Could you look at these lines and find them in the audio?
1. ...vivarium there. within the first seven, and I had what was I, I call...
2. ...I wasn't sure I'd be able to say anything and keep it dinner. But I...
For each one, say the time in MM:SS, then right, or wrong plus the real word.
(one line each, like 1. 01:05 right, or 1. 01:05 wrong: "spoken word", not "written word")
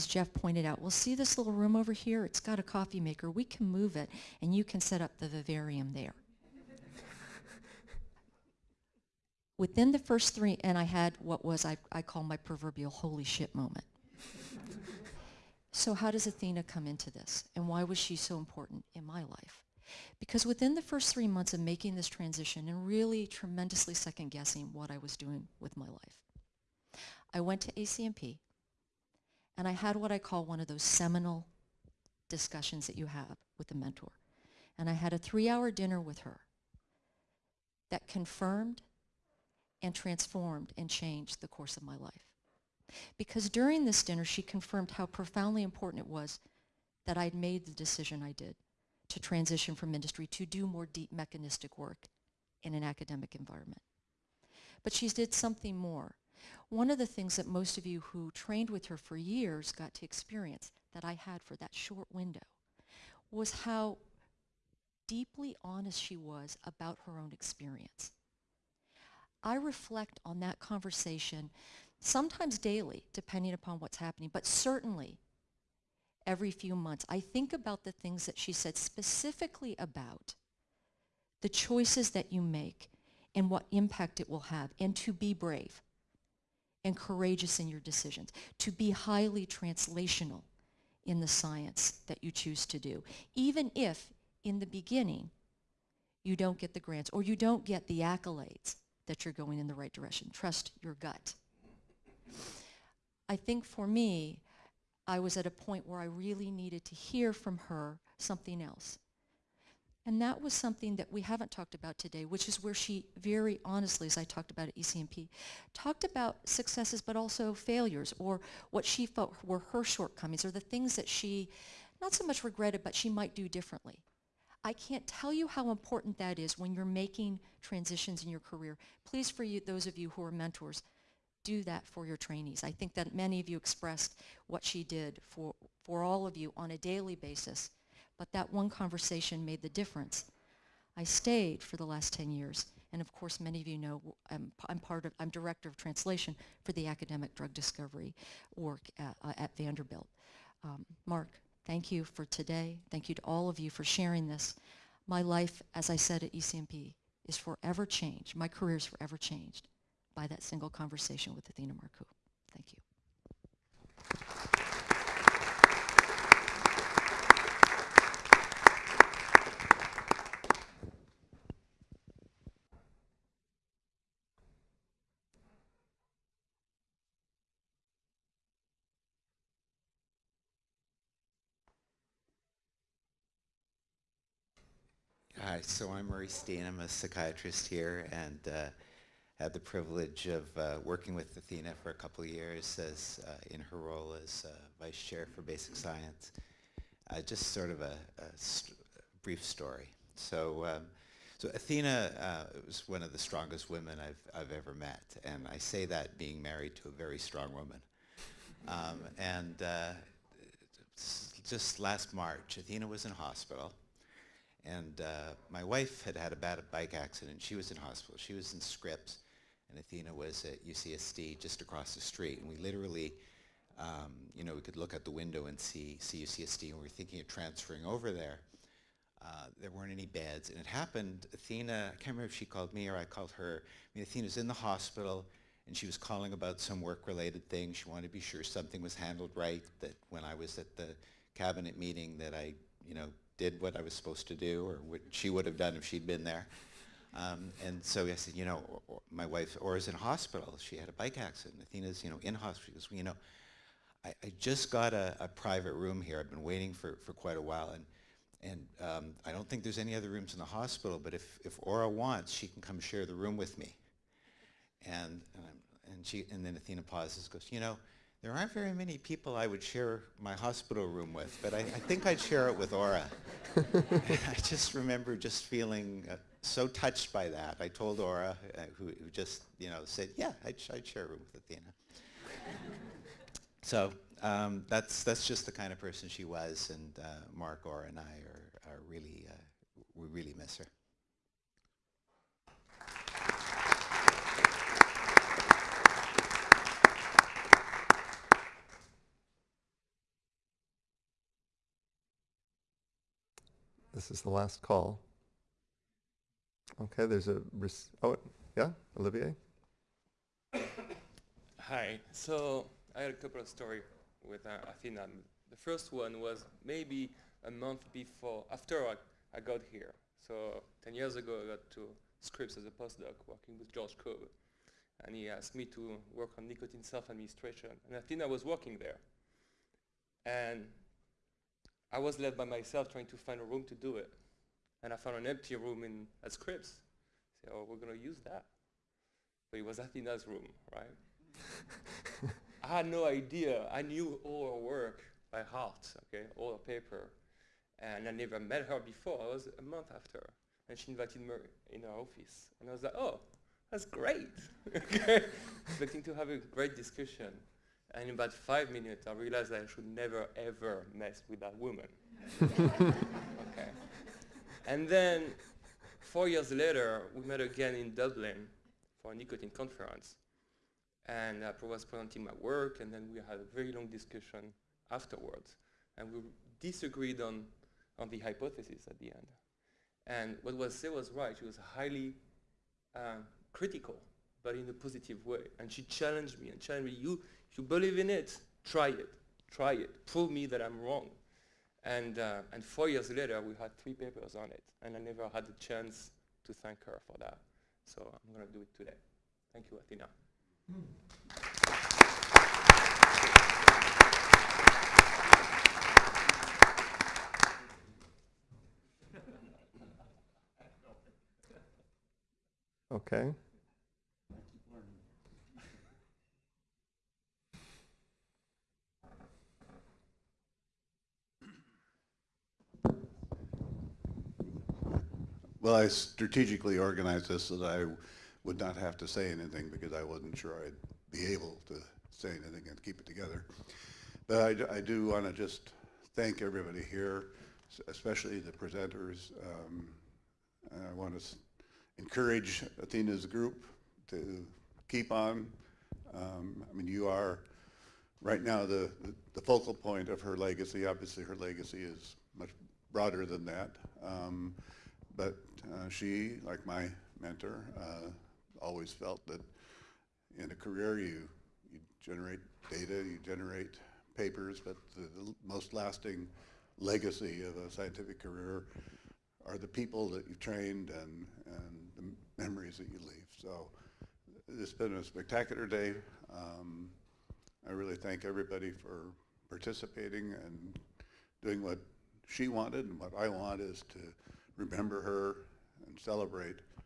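1. 00:05 wrong: "three", not "seven"
2. 07:09 wrong: "together", not "dinner".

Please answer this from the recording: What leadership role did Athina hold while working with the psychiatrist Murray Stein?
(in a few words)
Vice chair for basic science.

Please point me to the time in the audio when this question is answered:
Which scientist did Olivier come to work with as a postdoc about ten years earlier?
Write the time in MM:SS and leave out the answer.
05:23.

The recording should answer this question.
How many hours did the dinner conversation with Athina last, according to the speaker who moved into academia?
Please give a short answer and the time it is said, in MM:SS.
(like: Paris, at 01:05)
3, at 00:35.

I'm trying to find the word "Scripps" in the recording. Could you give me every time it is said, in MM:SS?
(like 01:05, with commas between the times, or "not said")
03:38, 05:22, 05:36.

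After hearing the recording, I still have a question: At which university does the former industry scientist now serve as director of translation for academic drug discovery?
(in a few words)
Vanderbilt.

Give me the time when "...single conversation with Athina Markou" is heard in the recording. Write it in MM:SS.
02:40.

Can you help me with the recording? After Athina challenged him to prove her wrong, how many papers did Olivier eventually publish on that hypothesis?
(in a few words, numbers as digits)
3.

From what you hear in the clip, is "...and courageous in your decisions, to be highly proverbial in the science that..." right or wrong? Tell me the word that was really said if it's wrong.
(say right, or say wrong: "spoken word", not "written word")
wrong: "translational", not "proverbial".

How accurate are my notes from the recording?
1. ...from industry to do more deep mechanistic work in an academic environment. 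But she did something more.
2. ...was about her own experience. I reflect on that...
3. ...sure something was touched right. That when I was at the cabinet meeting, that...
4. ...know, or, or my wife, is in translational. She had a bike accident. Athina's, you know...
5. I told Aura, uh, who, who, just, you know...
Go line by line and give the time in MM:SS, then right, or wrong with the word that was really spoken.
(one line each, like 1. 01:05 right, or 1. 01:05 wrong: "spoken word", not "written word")
1. 00:49 right
2. 01:06 right
3. 03:58 wrong: "handled", not "touched"
4. 04:08 wrong: "hospital", not "translational"
5. 04:37 right.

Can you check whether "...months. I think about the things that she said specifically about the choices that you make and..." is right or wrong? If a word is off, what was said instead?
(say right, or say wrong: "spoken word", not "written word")
right.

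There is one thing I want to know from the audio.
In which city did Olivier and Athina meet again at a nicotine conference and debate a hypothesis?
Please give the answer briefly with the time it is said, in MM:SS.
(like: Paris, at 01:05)
Dublin, at 06:07.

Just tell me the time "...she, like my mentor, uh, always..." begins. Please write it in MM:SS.
07:35.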